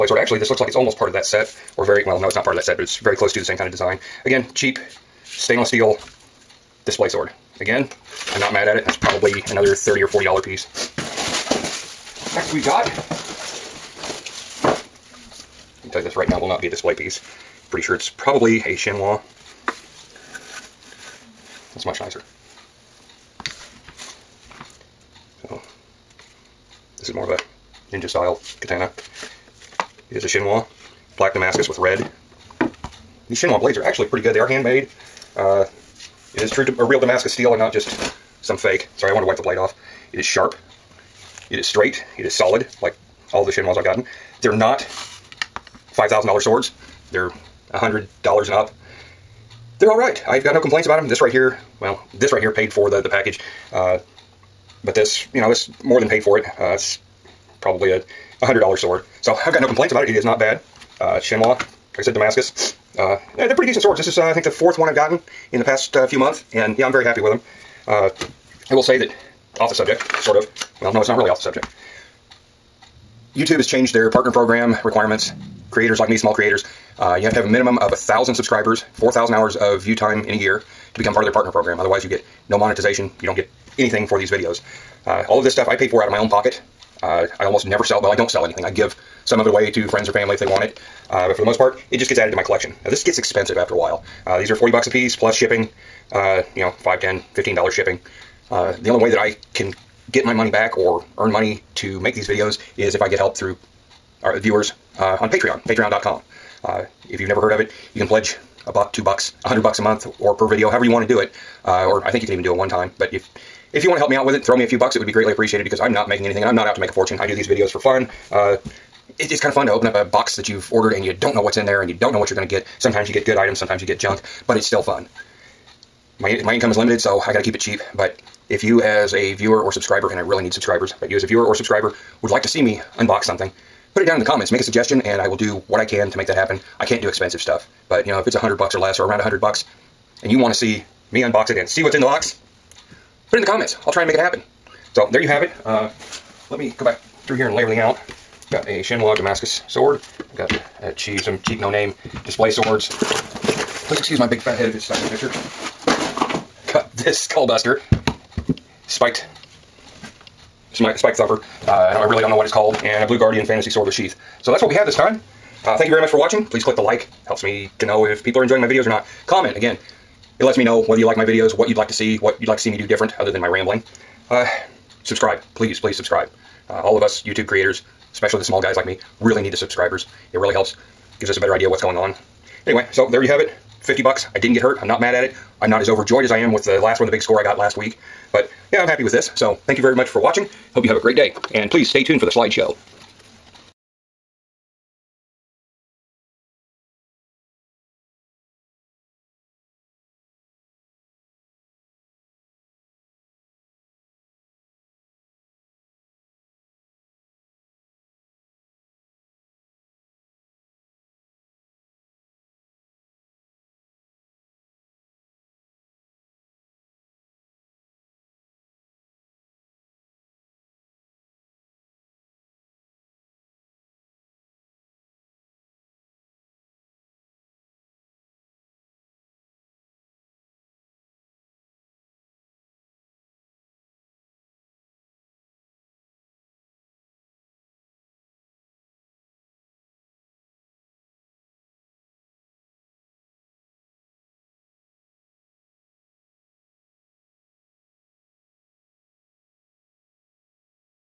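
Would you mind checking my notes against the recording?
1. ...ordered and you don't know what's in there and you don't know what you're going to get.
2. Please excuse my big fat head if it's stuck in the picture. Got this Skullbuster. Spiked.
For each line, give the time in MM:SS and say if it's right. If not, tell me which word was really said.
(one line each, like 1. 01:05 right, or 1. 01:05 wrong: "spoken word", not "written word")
1. 02:00 right
2. 02:33 right.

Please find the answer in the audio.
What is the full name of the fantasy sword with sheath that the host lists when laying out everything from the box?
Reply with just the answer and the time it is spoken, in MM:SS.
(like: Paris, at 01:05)
Blue Guardian Fantasy Sword, at 02:43.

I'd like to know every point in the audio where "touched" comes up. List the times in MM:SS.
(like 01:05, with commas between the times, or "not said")
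not said.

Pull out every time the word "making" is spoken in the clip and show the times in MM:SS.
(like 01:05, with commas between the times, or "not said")
01:56.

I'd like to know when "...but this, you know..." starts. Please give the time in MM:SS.
00:54.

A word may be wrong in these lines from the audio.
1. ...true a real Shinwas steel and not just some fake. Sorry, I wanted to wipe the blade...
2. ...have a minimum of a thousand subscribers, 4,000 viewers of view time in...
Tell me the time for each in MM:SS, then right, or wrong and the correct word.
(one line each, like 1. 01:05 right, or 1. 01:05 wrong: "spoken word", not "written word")
1. 00:36 wrong: "Damascus", not "Shinwas"
2. 01:17 wrong: "hours", not "viewers".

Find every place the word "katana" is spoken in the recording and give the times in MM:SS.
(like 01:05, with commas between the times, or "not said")
00:28.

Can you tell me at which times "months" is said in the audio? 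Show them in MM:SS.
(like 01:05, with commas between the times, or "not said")
01:06, 01:49.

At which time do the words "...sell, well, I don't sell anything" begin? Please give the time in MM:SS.
01:27.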